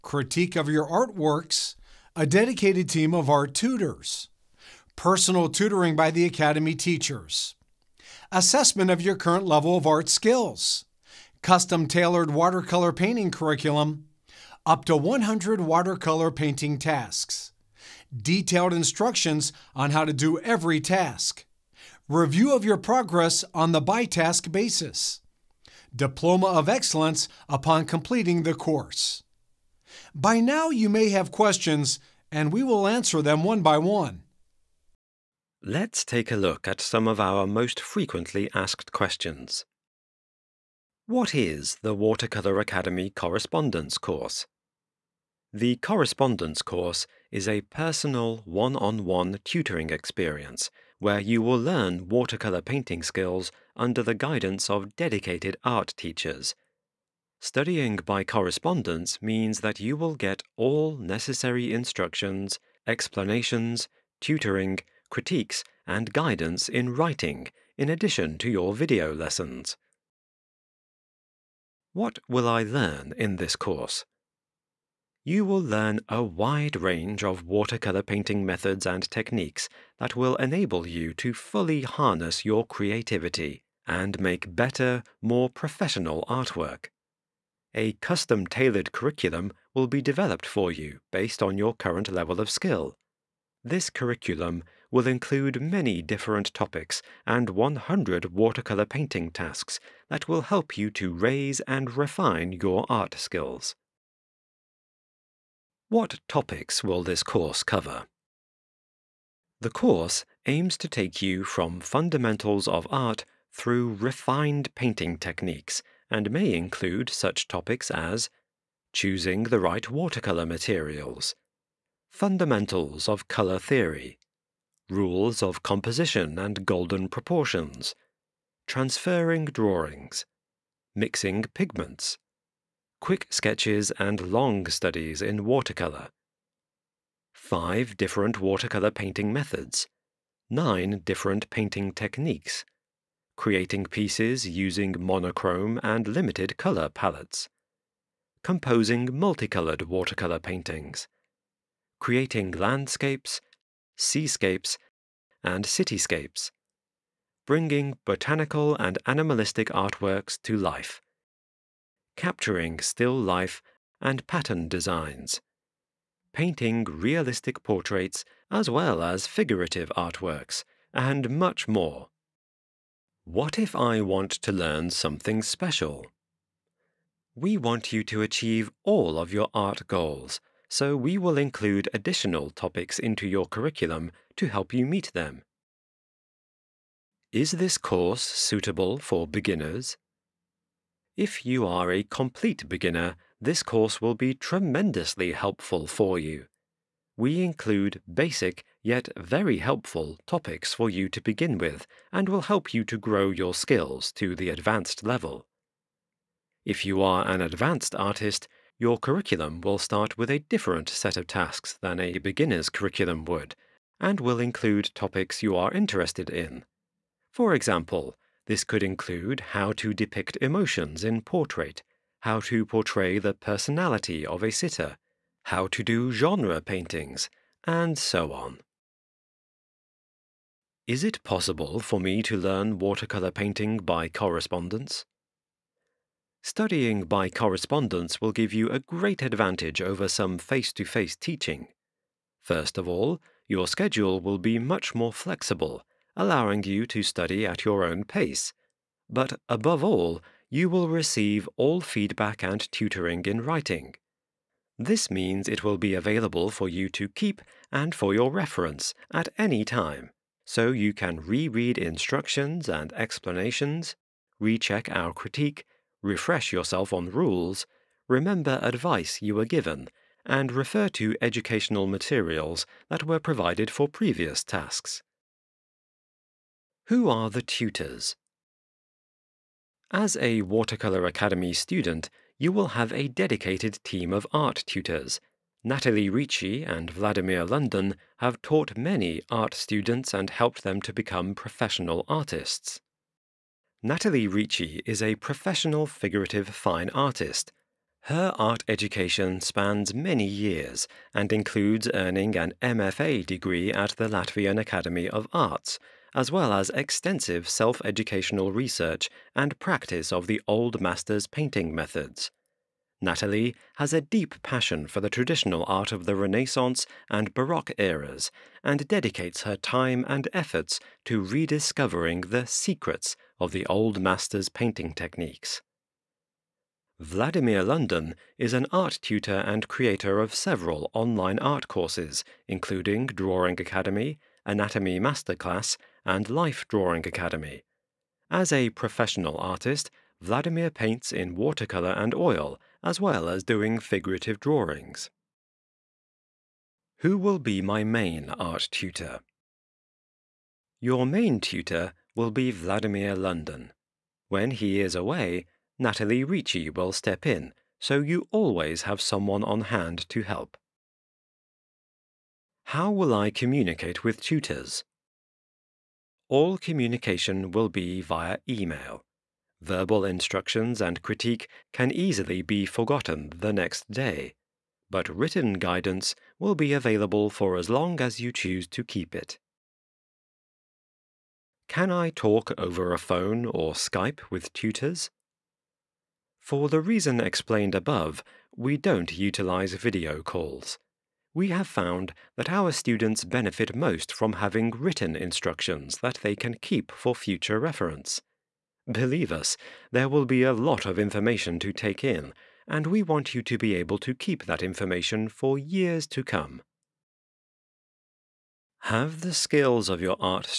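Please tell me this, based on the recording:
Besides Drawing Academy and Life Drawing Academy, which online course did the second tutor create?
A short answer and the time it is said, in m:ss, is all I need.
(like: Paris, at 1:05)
Anatomy Masterclass, at 5:34.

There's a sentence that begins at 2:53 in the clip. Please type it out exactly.
What if I want to learn something special?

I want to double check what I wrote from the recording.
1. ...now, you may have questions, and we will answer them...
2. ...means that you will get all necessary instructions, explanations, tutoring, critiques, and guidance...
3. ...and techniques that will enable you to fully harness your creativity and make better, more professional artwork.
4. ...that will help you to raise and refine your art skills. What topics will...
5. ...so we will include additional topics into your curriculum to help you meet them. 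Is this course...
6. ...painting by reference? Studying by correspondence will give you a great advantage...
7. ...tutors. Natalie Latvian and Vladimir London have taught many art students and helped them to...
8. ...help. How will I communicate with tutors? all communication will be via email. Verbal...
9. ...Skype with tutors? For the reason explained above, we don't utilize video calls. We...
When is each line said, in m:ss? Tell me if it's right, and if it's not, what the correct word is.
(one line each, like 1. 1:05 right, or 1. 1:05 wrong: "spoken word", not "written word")
1. 0:30 right
2. 0:59 right
3. 1:18 right
4. 1:40 right
5. 3:00 right
6. 3:53 wrong: "correspondence", not "reference"
7. 4:44 wrong: "Ricci", not "Latvian"
8. 6:00 right
9. 6:23 right.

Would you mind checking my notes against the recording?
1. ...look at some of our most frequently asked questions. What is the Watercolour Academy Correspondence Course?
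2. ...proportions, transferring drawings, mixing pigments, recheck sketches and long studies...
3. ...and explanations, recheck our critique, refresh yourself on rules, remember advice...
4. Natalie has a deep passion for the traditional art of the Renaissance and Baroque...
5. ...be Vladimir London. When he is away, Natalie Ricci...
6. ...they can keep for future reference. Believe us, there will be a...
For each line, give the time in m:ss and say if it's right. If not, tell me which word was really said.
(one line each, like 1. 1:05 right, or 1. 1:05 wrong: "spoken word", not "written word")
1. 0:36 right
2. 2:07 wrong: "quick", not "recheck"
3. 4:22 right
4. 5:13 right
5. 5:52 right
6. 6:36 right.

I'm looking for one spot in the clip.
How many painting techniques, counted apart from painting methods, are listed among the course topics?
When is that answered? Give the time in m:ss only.
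2:20.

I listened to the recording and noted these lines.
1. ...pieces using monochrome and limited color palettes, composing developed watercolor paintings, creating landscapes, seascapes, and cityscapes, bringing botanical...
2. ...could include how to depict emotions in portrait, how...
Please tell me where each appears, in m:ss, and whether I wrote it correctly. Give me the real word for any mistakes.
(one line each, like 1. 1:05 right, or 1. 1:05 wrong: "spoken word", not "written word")
1. 2:23 wrong: "multicolored", not "developed"
2. 3:38 right.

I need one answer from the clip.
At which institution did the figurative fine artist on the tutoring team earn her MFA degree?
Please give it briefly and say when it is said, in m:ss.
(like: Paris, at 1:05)
Latvian Academy of Arts, at 5:04.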